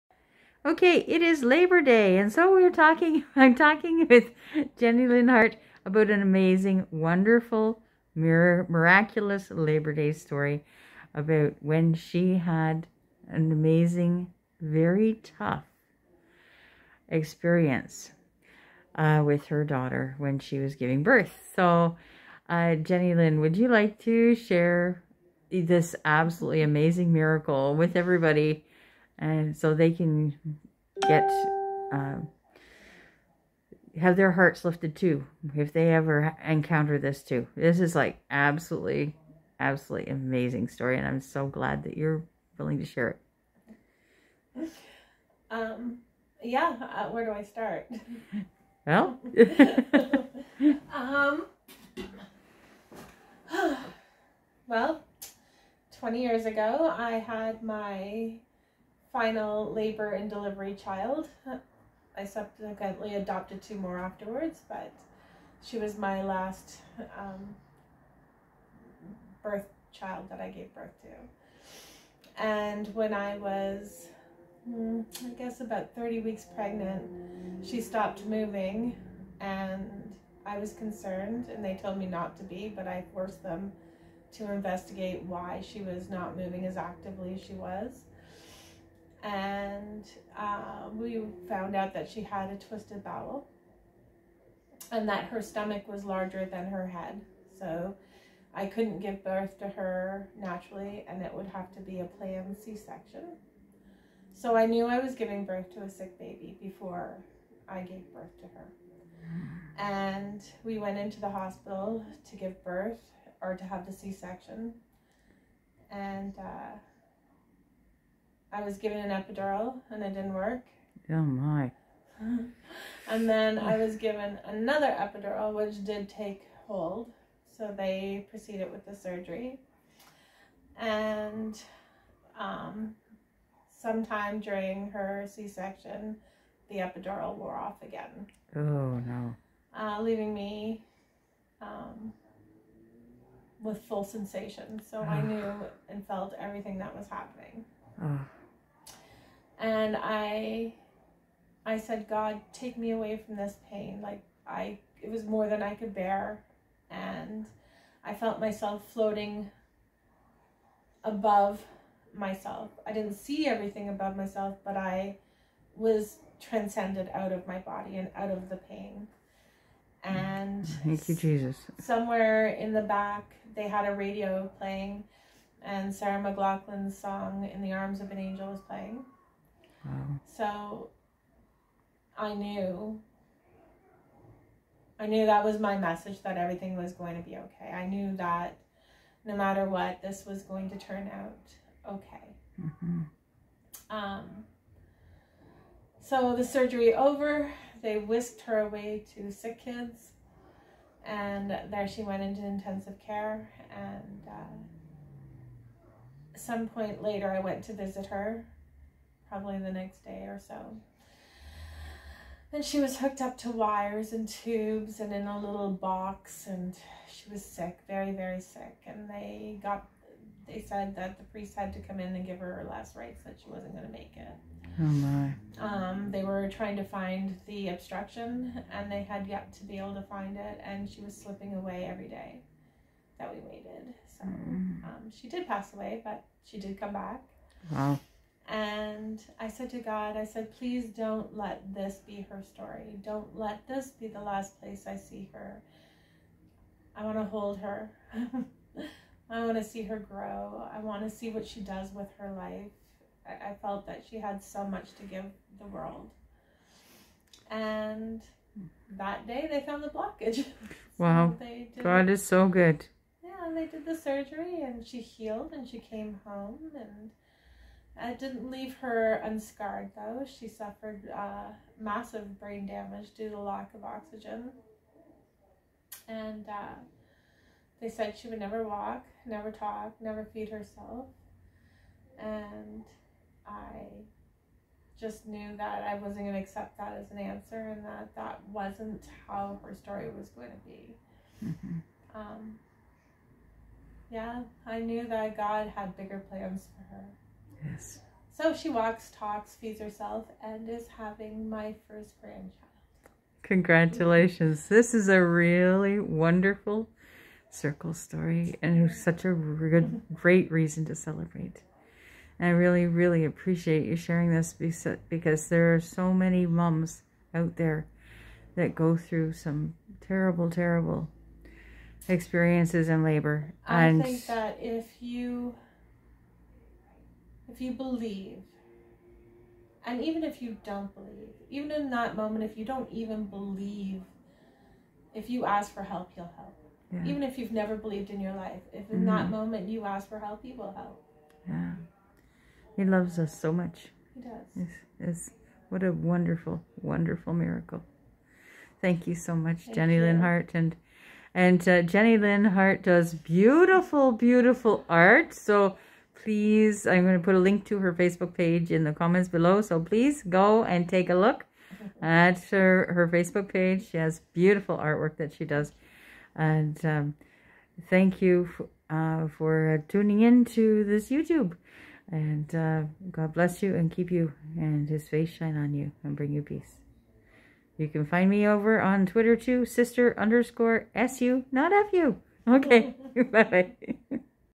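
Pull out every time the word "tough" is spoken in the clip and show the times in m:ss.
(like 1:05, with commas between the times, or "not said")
0:15.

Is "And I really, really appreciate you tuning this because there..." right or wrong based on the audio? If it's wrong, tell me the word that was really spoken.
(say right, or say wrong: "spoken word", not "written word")
wrong: "sharing", not "tuning".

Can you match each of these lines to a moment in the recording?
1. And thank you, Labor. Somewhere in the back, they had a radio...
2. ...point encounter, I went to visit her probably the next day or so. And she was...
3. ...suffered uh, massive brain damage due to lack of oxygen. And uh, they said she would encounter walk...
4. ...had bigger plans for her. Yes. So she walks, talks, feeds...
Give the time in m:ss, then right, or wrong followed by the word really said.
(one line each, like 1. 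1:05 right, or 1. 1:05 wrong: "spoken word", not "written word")
1. 2:50 wrong: "Jesus", not "Labor"
2. 3:26 wrong: "later", not "encounter"
3. 4:30 wrong: "never", not "encounter"
4. 4:55 right.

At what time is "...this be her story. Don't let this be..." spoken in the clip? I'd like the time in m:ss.
4:01.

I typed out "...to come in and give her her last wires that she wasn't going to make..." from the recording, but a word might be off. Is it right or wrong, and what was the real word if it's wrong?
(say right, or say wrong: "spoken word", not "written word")
wrong: "rites", not "wires".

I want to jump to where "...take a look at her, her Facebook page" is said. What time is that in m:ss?
6:00.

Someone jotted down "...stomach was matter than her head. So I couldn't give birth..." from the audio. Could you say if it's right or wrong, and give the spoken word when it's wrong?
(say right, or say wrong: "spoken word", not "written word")
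wrong: "larger", not "matter".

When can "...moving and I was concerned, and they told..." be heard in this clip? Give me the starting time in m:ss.
1:18.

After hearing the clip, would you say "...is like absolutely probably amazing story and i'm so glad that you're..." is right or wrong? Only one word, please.
wrong.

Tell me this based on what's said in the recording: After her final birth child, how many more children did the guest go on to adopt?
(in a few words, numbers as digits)
2.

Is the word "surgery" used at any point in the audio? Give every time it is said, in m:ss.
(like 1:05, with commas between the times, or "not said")
2:08, 3:16, 4:23.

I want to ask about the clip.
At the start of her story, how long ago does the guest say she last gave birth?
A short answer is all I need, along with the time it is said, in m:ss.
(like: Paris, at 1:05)
20 years ago, at 0:55.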